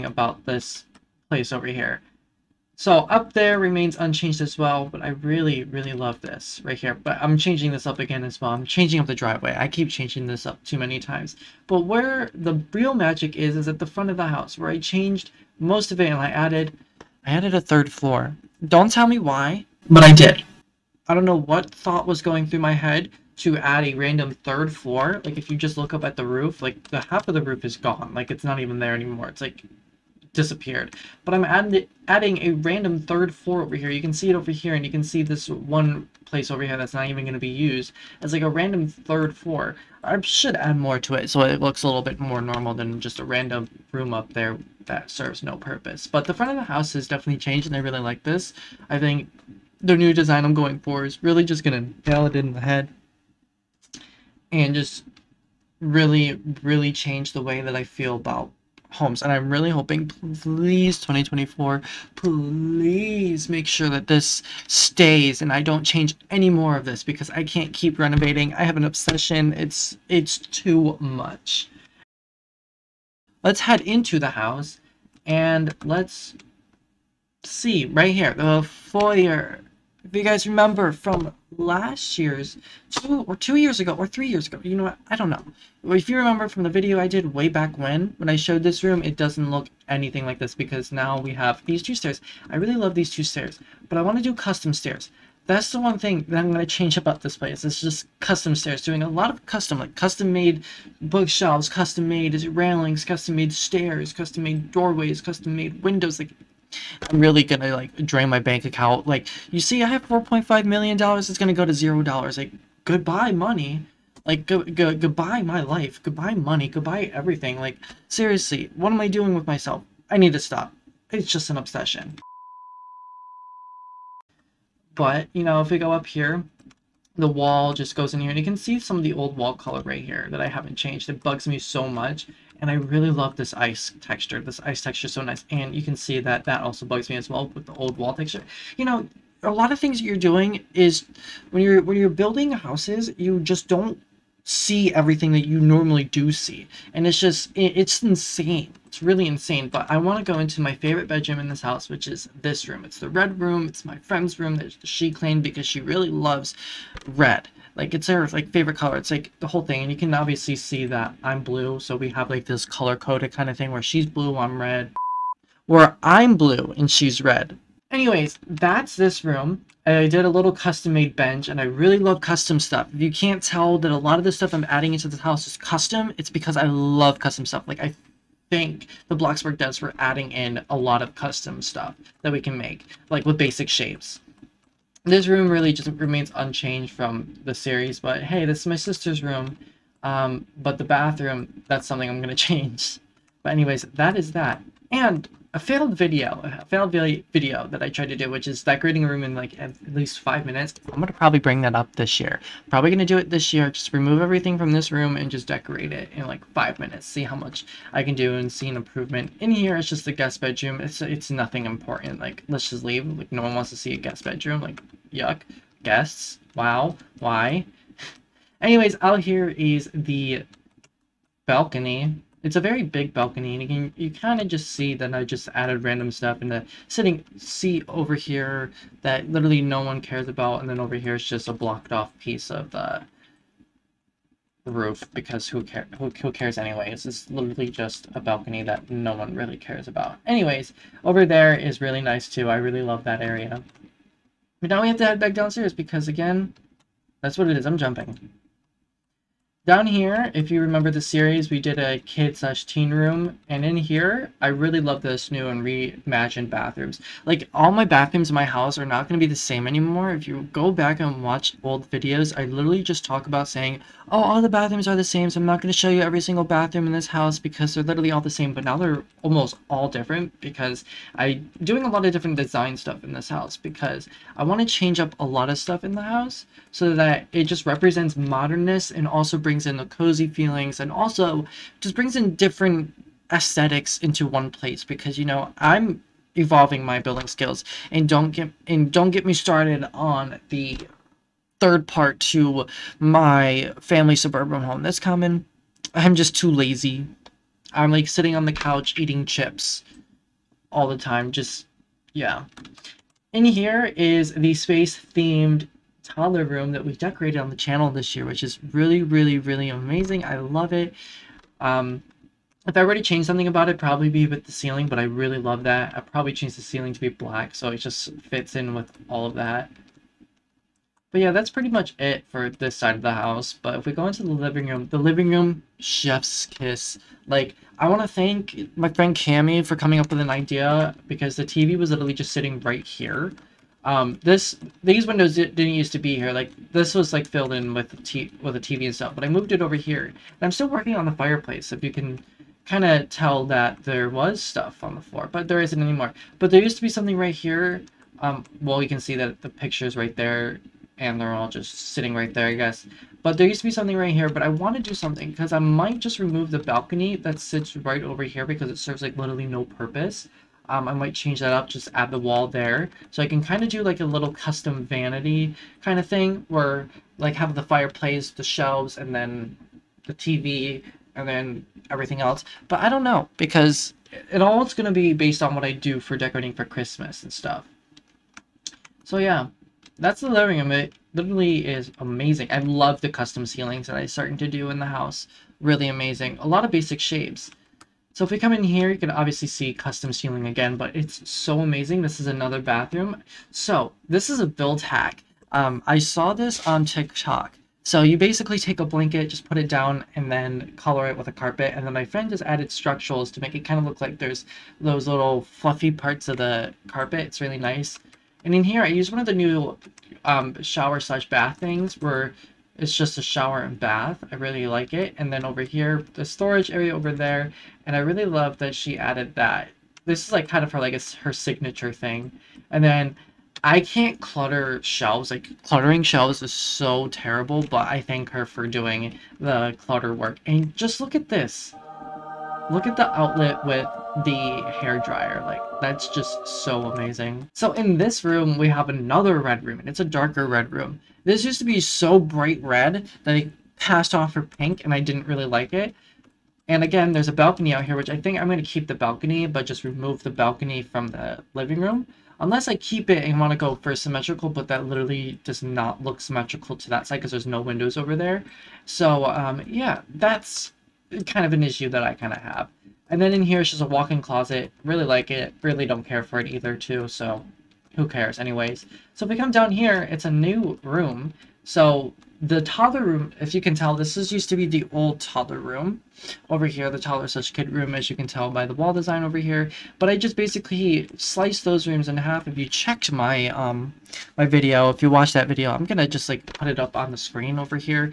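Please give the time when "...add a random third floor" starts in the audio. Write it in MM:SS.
00:23.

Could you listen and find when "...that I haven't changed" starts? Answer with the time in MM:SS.
02:10.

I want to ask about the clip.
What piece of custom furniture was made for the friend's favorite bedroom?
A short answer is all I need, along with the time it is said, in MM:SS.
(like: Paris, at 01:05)
Bench, at 02:50.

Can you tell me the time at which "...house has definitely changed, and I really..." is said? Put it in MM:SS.
00:46.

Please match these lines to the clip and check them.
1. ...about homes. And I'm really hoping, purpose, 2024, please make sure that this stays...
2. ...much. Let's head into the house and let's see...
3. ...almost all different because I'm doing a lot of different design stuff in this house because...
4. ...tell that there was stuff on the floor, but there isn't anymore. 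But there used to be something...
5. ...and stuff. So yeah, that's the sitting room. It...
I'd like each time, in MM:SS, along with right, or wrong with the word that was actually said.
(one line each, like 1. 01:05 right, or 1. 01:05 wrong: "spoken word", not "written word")
1. 00:58 wrong: "please", not "purpose"
2. 01:11 right
3. 04:29 right
4. 05:43 right
5. 06:17 wrong: "living", not "sitting".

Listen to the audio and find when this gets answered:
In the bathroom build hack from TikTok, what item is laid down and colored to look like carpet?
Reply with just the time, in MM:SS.
06:38.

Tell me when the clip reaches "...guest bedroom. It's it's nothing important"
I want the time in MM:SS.
03:30.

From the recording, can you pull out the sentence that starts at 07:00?
This is like kind of her, like, her signature thing.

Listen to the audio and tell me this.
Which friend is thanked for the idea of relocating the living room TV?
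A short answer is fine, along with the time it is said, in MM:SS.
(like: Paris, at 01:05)
Cami, at 05:29.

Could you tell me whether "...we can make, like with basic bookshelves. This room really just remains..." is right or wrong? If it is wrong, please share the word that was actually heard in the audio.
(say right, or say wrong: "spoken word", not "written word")
wrong: "shapes", not "bookshelves".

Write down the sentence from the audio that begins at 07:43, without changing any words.
And then in here, it's just a walk-in closet.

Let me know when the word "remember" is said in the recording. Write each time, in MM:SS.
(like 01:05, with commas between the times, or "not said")
01:20, 01:26, 04:10.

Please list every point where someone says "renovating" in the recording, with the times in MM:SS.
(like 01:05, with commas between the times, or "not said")
01:07.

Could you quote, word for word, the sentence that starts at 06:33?
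So this is a build hack.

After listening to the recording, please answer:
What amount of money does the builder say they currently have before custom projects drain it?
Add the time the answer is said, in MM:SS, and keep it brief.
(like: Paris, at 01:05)
$4.5 million, at 01:50.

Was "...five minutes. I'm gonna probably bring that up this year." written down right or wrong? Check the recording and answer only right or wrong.
right.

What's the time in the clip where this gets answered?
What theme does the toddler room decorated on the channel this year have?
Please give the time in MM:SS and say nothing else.
05:04.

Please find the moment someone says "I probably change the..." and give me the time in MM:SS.
05:15.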